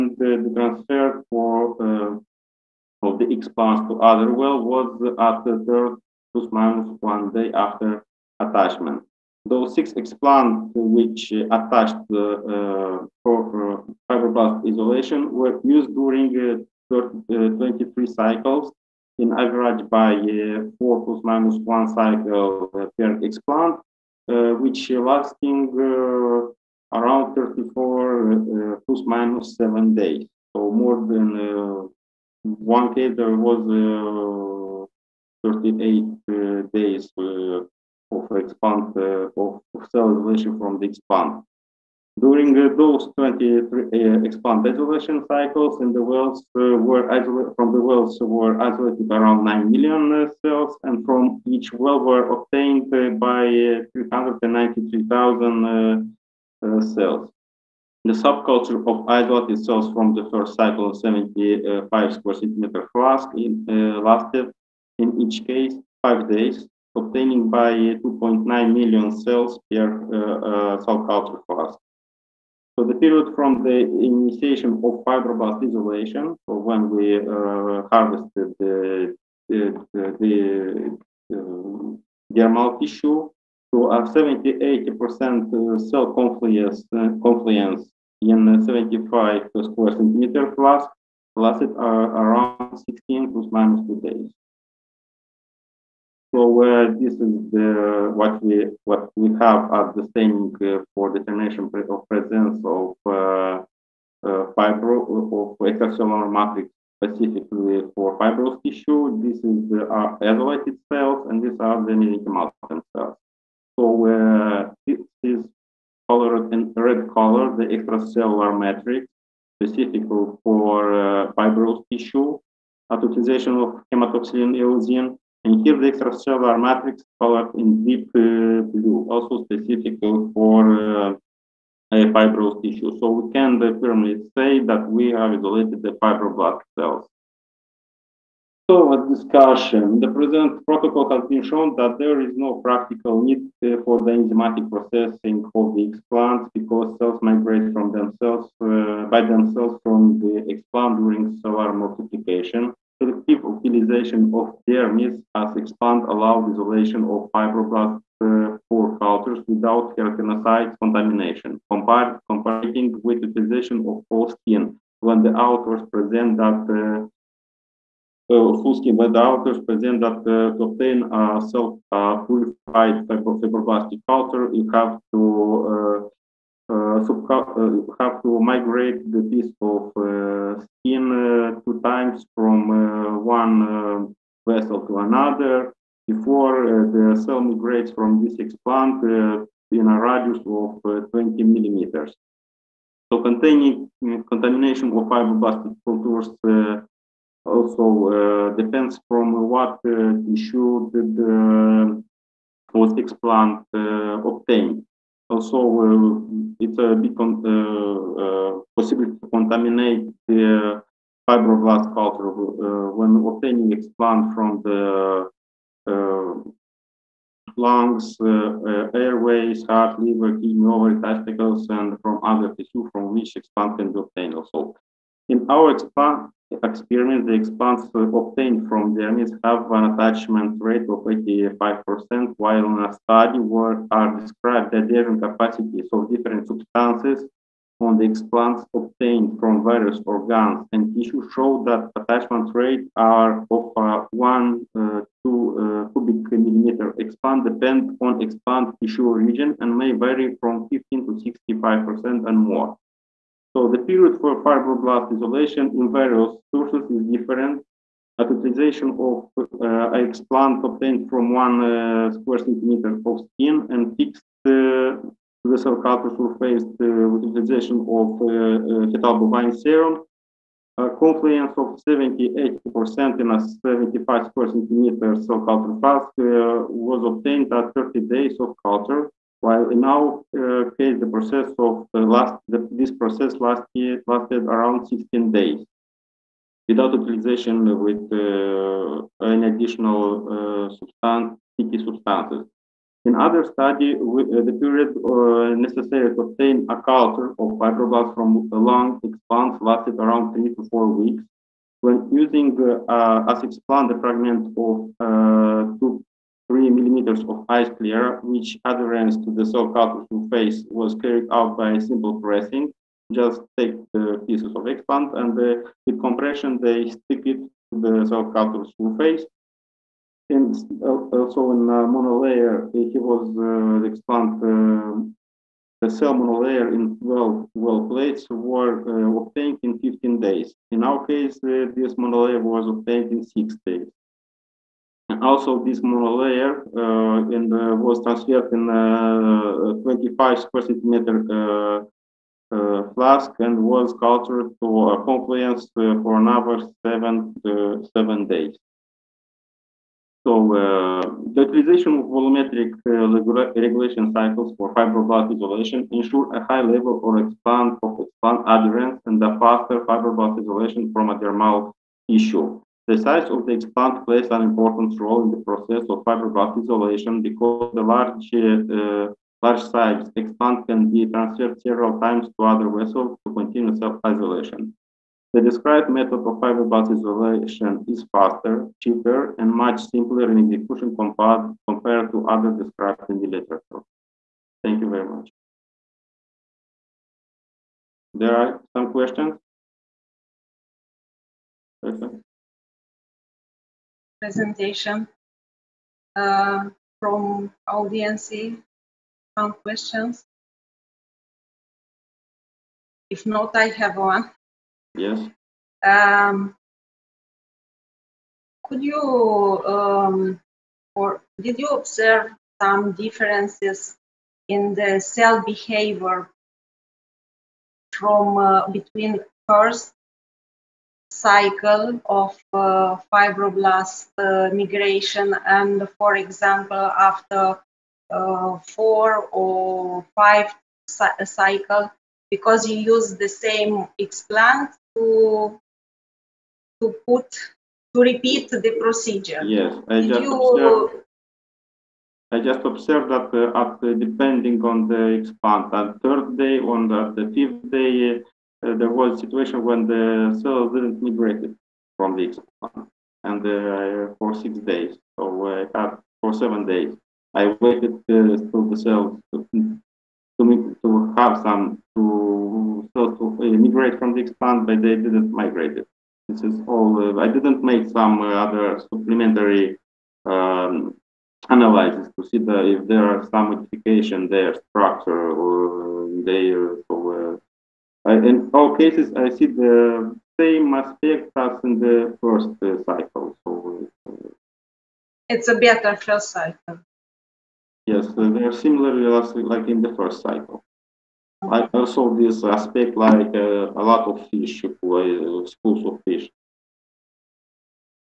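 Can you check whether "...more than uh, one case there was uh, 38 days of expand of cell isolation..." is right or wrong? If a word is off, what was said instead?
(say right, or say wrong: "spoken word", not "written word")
right.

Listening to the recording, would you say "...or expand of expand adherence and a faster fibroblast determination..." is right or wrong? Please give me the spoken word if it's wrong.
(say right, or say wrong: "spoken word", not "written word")
wrong: "isolation", not "determination".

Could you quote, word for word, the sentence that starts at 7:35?
So I uh, had for seven days.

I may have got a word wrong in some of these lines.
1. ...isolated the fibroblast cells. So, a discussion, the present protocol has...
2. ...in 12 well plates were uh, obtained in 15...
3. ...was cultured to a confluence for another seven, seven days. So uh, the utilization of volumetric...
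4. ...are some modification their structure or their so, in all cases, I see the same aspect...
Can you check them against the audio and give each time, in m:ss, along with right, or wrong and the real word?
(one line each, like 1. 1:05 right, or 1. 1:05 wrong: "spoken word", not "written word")
1. 2:15 right
2. 5:26 right
3. 5:43 right
4. 7:53 right.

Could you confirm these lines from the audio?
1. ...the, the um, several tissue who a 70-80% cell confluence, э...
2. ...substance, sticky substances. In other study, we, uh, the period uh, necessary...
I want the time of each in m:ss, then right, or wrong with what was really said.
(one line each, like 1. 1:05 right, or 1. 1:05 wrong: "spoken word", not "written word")
1. 1:19 wrong: "dermal", not "several"
2. 4:50 right.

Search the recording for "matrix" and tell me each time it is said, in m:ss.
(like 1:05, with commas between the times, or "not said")
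1:46, 1:58, 2:06.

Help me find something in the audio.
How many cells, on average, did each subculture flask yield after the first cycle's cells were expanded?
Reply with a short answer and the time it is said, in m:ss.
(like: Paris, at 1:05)
2.9 million, at 1:07.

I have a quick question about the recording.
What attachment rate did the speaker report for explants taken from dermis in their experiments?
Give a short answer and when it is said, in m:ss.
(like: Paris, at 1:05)
85%, at 3:51.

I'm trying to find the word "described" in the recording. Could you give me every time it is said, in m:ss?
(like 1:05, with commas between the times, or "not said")
3:54, 6:15, 6:22.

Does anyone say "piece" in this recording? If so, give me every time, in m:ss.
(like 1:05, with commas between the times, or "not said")
2:59, 5:14.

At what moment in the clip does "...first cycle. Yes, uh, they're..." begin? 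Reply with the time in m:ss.
8:05.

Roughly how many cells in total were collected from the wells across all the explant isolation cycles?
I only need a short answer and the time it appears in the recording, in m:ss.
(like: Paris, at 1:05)
9 million, at 0:49.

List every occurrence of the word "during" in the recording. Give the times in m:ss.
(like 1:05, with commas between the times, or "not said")
0:15, 0:42, 2:30.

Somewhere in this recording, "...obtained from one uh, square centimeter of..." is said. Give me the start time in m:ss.
4:20.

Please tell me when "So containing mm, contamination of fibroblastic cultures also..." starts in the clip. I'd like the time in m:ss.
3:13.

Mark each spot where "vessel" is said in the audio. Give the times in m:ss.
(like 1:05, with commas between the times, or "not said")
3:04, 6:12.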